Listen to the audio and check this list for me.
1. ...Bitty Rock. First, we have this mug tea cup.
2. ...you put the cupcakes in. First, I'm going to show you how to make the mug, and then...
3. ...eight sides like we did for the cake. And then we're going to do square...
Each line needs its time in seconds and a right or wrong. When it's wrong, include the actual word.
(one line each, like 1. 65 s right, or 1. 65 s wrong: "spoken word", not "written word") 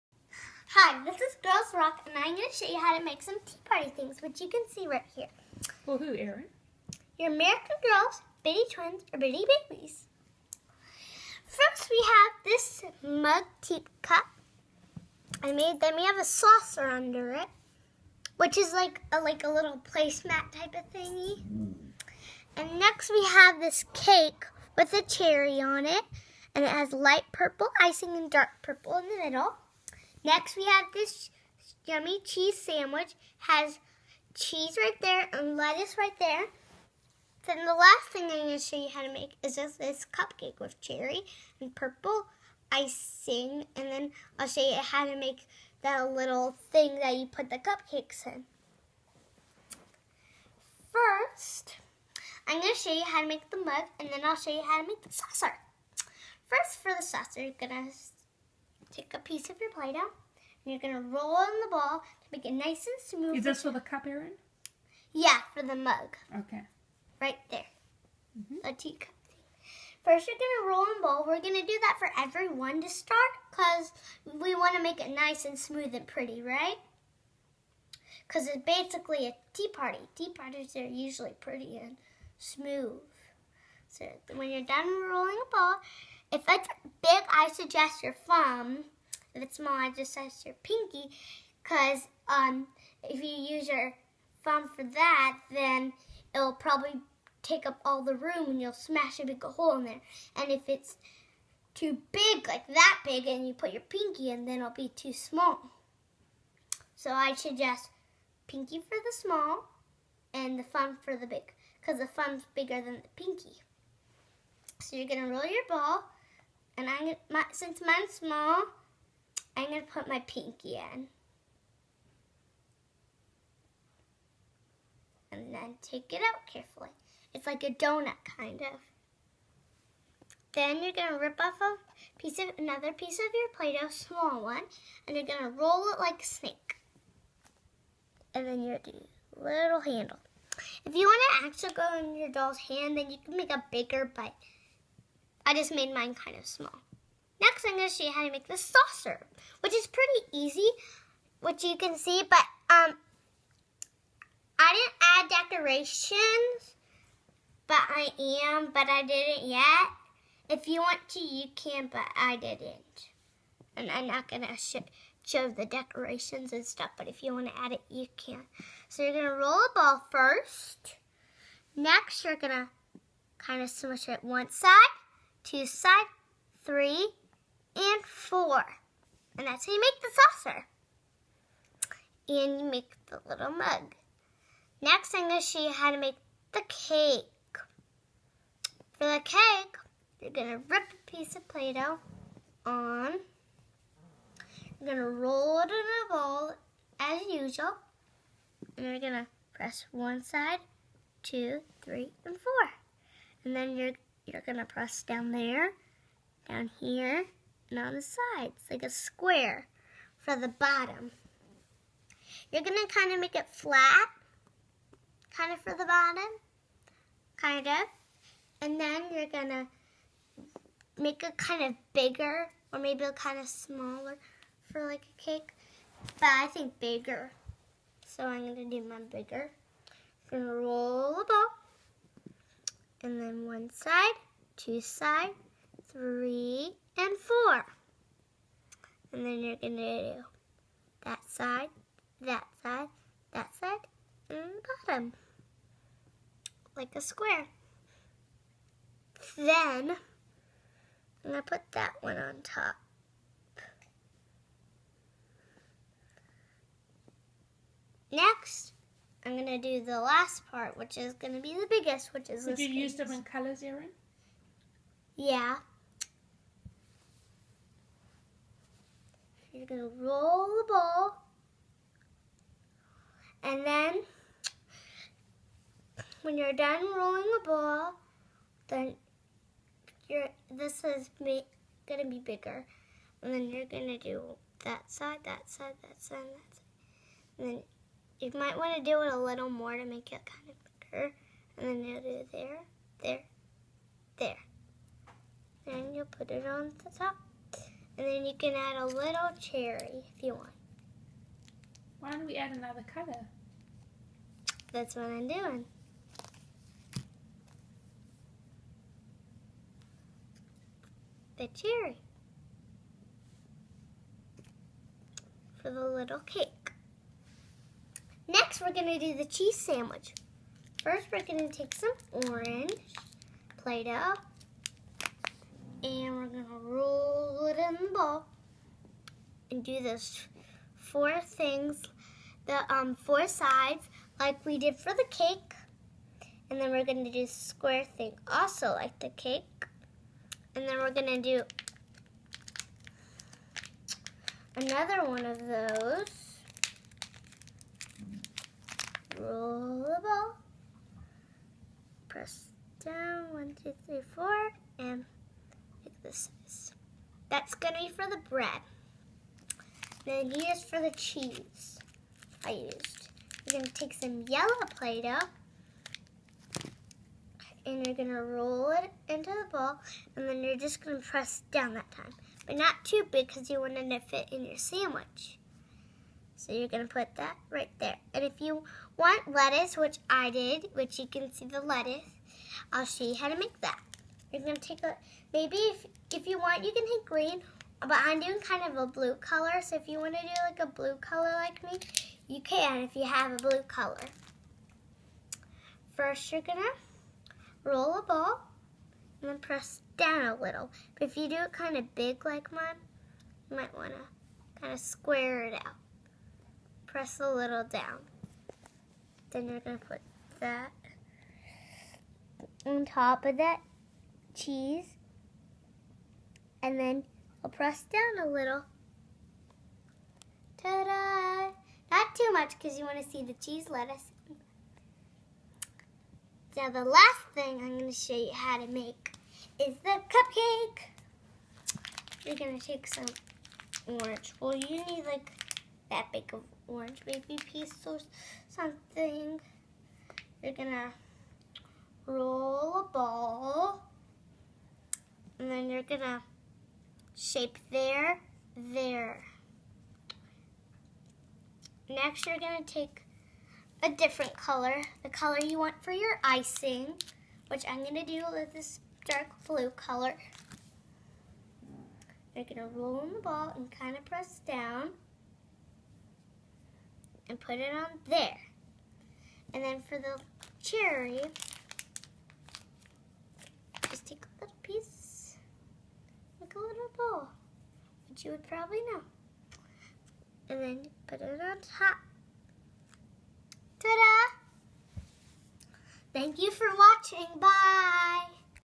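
1. 9 s wrong: "Babies", not "Rock"
2. 47 s right
3. 332 s wrong: "four", not "eight".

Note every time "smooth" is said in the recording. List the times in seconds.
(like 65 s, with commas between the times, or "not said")
63 s, 75 s, 82 s.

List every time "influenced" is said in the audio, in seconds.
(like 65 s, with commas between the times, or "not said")
not said.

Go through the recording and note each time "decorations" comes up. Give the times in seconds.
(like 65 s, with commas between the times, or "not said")
155 s, 165 s.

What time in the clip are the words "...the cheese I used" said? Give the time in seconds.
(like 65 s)
360 s.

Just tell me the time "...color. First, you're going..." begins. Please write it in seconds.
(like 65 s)
393 s.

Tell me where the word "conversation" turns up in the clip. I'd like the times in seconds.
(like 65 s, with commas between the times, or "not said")
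not said.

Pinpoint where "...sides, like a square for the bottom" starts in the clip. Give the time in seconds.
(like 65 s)
208 s.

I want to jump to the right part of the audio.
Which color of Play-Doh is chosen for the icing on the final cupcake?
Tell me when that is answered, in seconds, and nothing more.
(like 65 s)
459 s.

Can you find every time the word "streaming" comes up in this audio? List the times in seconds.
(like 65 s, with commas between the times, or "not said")
not said.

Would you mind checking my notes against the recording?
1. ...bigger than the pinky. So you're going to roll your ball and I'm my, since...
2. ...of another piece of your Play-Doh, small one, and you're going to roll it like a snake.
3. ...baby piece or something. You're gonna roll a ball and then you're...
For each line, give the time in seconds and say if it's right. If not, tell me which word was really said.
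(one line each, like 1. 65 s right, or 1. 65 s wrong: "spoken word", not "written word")
1. 112 s right
2. 132 s right
3. 437 s right.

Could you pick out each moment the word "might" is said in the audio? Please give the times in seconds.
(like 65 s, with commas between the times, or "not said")
288 s, 403 s.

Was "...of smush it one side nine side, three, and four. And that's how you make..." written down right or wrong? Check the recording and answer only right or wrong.
wrong.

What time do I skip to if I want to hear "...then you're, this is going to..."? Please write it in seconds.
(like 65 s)
278 s.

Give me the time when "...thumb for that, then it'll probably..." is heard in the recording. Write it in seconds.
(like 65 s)
94 s.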